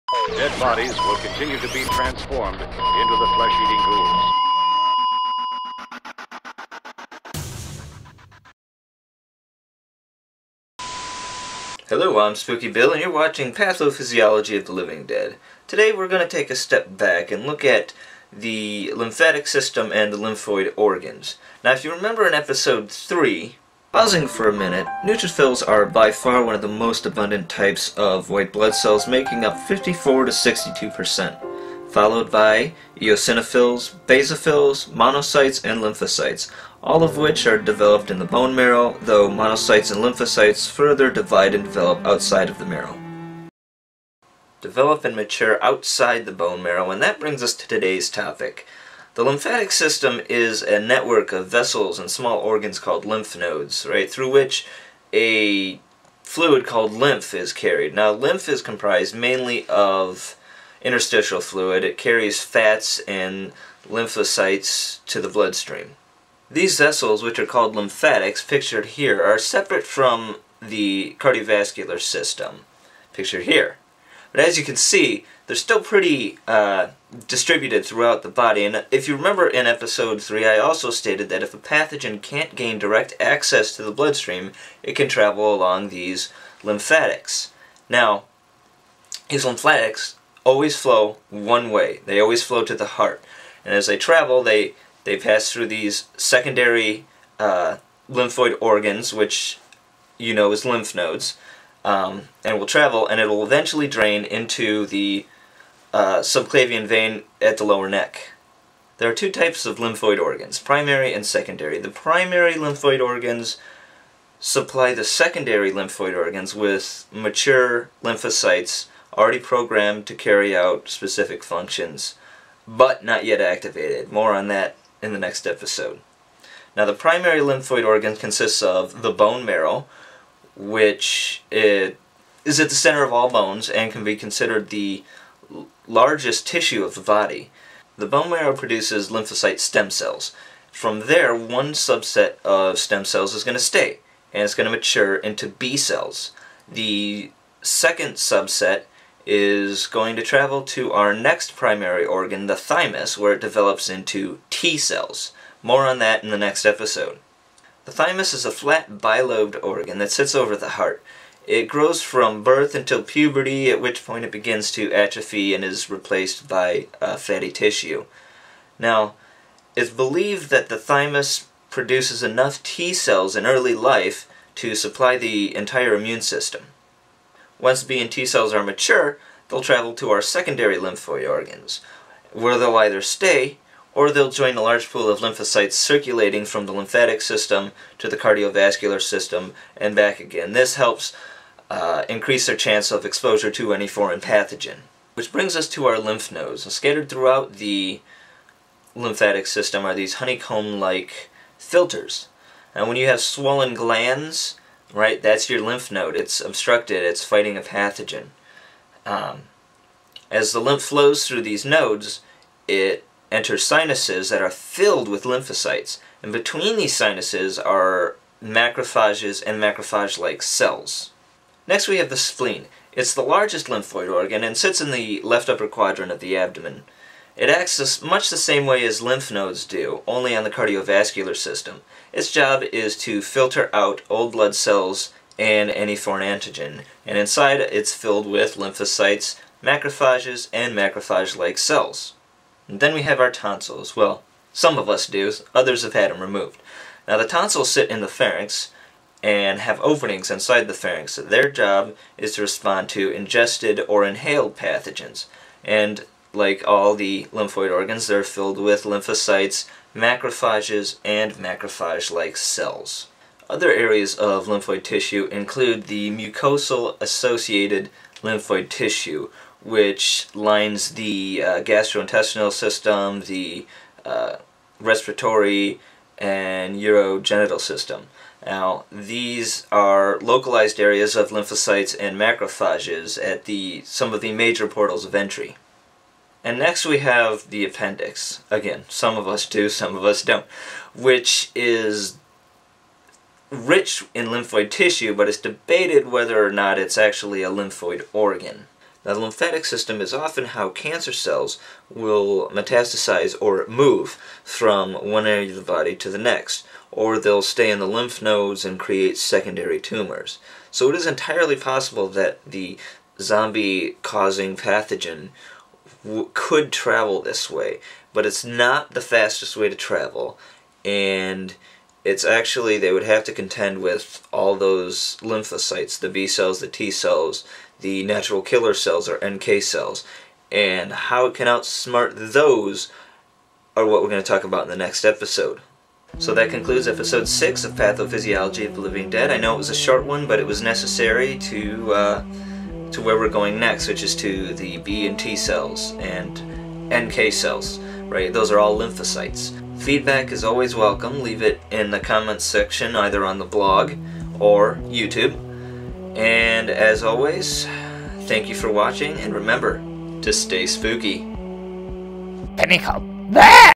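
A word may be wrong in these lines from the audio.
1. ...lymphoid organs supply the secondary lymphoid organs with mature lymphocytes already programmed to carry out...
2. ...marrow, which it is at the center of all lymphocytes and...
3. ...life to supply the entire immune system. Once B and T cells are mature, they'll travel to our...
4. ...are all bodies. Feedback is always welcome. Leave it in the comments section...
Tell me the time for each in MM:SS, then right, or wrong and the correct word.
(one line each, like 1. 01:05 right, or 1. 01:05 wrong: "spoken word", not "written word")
1. 01:52 right
2. 02:09 wrong: "bones", not "lymphocytes"
3. 02:53 right
4. 05:48 wrong: "lymphocytes", not "bodies".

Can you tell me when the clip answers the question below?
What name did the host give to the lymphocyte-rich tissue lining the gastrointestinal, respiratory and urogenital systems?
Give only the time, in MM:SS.
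04:26.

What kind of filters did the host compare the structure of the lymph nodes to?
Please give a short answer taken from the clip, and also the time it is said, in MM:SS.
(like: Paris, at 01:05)
Honeycomb-like, at 03:20.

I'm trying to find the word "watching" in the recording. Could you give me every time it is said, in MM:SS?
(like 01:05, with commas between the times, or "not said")
00:13, 05:58.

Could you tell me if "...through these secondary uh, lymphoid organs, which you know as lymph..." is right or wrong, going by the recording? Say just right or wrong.
right.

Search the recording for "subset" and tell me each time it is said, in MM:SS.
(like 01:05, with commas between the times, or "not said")
02:21, 02:28.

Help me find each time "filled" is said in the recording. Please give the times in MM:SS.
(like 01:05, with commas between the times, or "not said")
03:34, 03:57, 04:18.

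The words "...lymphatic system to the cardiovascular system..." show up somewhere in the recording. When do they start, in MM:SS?
03:06.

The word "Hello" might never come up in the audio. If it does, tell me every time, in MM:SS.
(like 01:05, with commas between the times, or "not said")
00:11.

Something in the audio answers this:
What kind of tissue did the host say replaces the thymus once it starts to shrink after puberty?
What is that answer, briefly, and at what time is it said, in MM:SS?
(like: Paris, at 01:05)
Fatty tissue, at 02:47.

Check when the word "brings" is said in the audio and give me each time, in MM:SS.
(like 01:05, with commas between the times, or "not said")
00:47, 03:15.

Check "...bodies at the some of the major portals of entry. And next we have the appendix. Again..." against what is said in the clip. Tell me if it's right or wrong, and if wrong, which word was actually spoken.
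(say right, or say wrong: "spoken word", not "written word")
wrong: "macrophages", not "bodies".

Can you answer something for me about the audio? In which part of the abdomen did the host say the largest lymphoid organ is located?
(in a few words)
Left upper quadrant.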